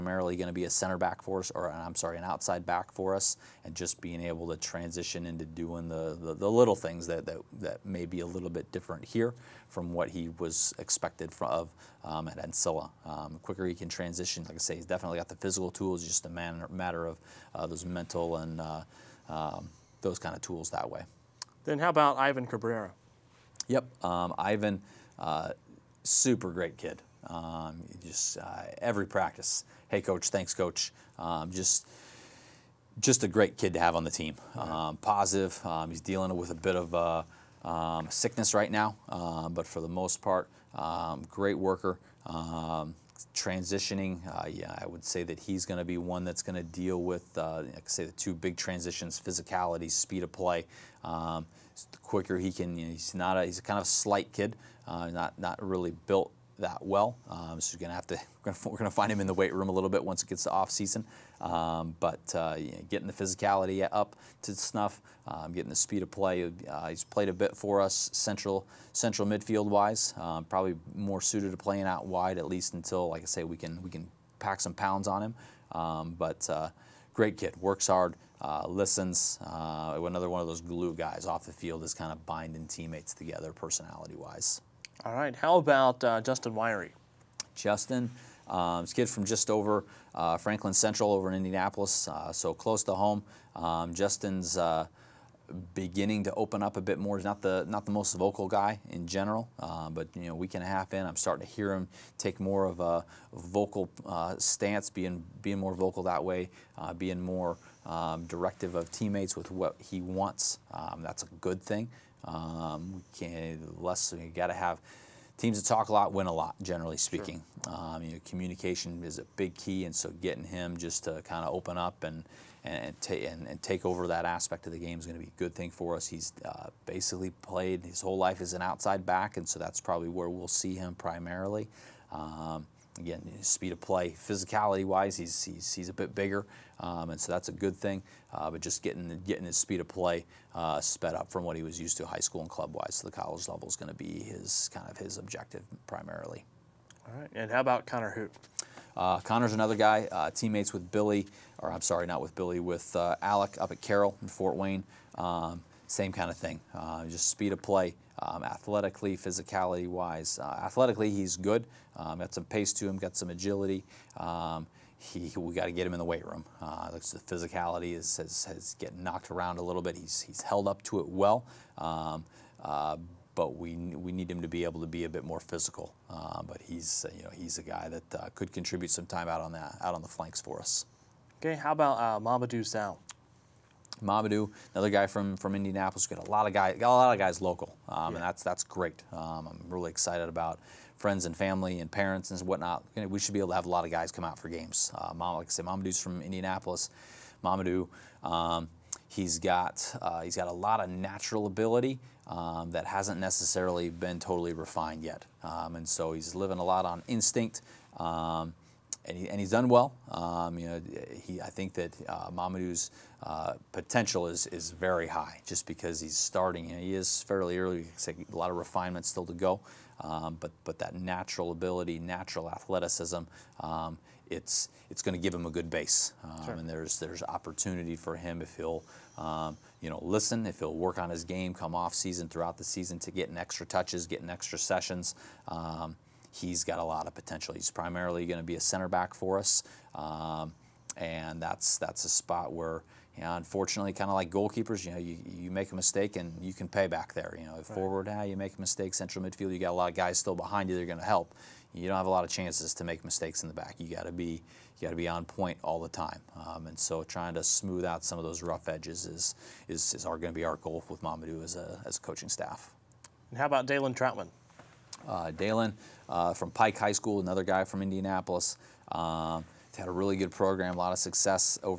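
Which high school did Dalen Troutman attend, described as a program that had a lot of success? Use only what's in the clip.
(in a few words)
Pike High School.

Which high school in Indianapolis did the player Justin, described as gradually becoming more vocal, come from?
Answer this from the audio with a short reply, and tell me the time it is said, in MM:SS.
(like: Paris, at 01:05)
Franklin Central, at 01:30.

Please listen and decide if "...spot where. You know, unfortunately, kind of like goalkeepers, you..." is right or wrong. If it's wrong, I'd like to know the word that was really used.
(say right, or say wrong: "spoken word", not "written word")
right.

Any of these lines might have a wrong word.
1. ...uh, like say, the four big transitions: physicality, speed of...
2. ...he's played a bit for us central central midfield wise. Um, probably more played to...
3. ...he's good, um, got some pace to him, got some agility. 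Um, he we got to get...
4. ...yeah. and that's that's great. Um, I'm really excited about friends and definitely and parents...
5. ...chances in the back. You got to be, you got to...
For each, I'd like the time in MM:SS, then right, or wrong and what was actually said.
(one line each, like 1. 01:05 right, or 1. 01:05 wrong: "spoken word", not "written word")
1. 00:47 wrong: "two", not "four"
2. 01:06 wrong: "suited", not "played"
3. 02:41 right
4. 03:08 wrong: "family", not "definitely"
5. 04:13 wrong: "mistakes", not "chances".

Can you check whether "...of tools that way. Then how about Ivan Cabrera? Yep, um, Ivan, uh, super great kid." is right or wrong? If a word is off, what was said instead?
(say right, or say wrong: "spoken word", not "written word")
right.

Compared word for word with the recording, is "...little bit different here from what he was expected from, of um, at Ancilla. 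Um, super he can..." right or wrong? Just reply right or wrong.
wrong.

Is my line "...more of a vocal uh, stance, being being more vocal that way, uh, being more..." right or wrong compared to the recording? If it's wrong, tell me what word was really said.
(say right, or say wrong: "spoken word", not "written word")
right.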